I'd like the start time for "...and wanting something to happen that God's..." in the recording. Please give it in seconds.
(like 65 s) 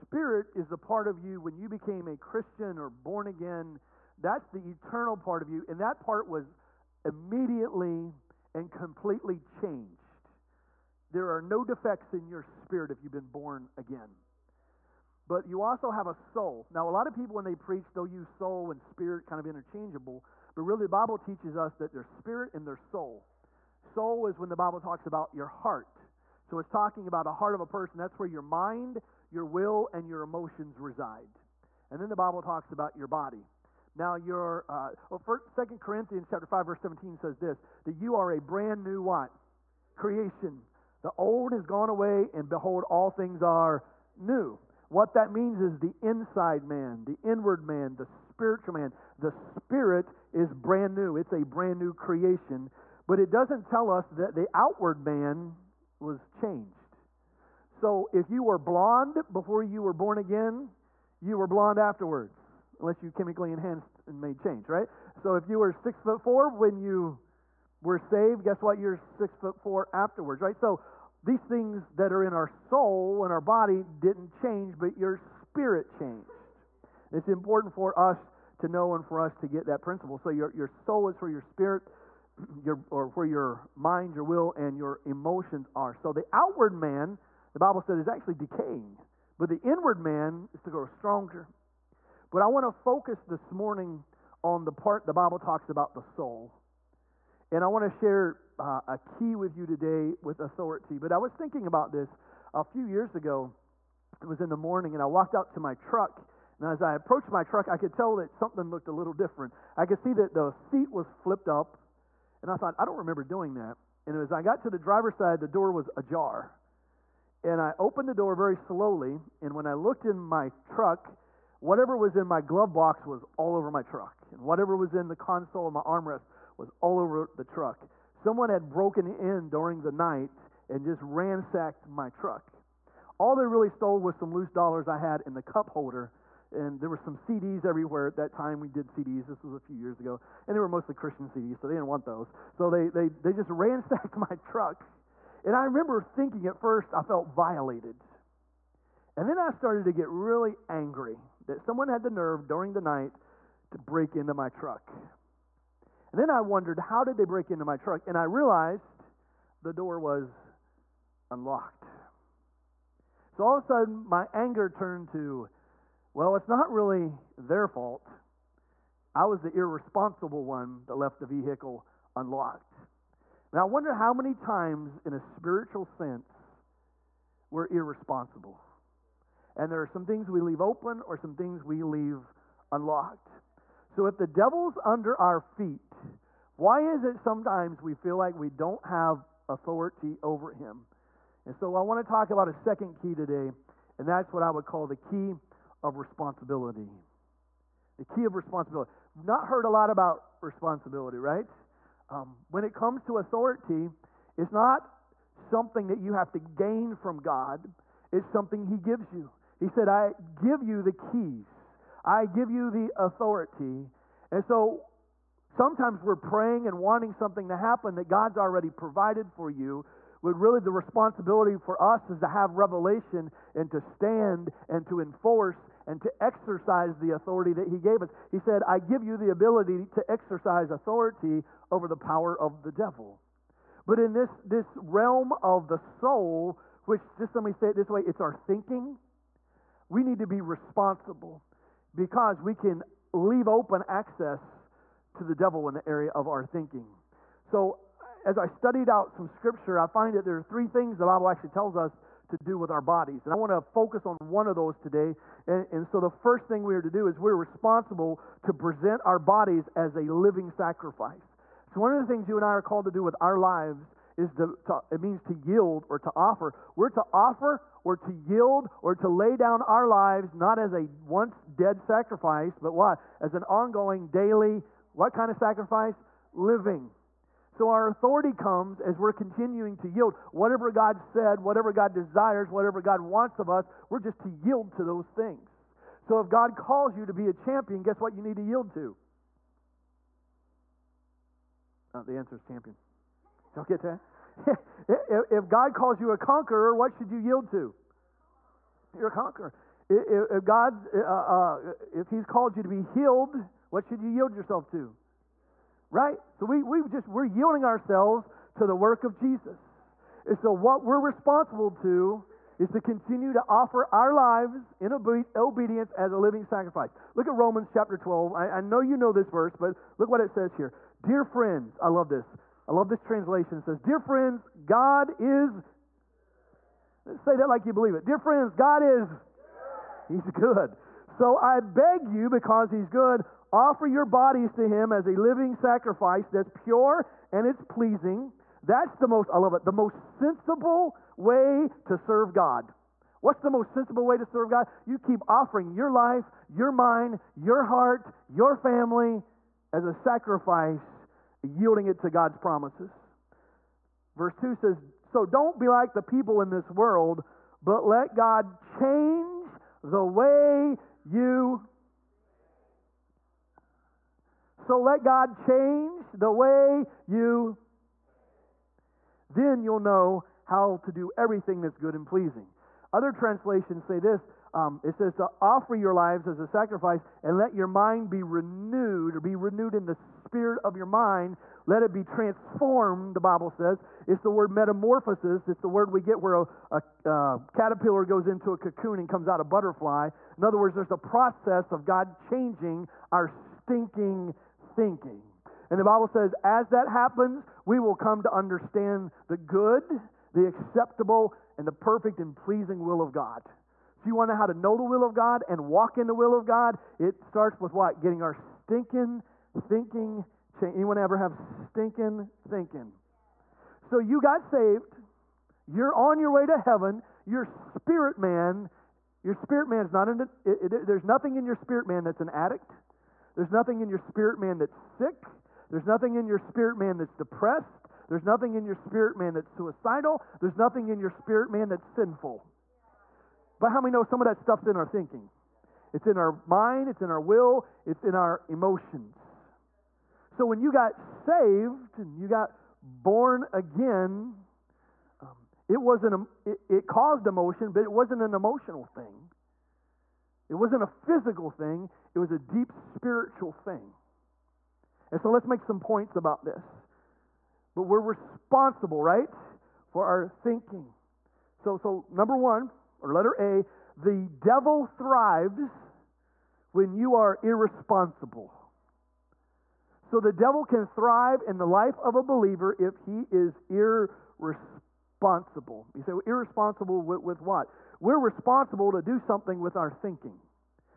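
216 s.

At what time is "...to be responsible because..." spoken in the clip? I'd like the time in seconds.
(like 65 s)
240 s.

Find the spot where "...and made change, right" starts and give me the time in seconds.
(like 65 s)
64 s.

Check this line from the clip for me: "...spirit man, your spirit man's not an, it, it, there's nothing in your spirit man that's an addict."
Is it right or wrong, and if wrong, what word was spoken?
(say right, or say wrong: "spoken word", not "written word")
right.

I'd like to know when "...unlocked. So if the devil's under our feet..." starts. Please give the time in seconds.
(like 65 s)
182 s.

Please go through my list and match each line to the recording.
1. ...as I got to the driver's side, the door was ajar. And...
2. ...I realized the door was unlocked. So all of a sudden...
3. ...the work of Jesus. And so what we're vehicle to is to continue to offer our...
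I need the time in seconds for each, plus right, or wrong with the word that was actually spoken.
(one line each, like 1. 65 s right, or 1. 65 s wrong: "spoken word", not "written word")
1. 114 s right
2. 158 s right
3. 308 s wrong: "responsible", not "vehicle".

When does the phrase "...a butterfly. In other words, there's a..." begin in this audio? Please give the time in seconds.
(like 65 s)
389 s.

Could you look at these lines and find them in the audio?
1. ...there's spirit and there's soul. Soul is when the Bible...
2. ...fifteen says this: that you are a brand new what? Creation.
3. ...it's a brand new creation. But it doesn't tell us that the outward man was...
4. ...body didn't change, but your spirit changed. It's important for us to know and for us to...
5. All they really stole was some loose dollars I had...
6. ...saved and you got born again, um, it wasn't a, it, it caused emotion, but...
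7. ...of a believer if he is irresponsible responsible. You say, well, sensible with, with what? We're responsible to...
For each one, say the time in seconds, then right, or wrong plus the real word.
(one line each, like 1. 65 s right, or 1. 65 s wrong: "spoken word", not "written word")
1. 21 s right
2. 36 s wrong: "seventeen", not "fifteen"
3. 51 s right
4. 73 s right
5. 133 s right
6. 440 s right
7. 472 s wrong: "irresponsible", not "sensible".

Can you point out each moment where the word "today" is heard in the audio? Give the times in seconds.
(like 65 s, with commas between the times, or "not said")
99 s, 193 s, 254 s.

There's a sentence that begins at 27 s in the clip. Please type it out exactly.
That's where your mind, your will, and your emotions reside.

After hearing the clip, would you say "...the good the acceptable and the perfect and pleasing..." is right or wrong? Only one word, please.
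right.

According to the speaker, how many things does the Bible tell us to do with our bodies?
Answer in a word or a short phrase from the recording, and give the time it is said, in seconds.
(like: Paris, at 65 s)
3, at 250 s.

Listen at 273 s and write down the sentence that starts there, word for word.
As an ongoing daily, what kind of sacrifice?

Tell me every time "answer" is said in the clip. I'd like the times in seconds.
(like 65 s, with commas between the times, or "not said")
292 s.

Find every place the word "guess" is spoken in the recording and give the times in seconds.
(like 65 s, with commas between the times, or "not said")
68 s, 287 s.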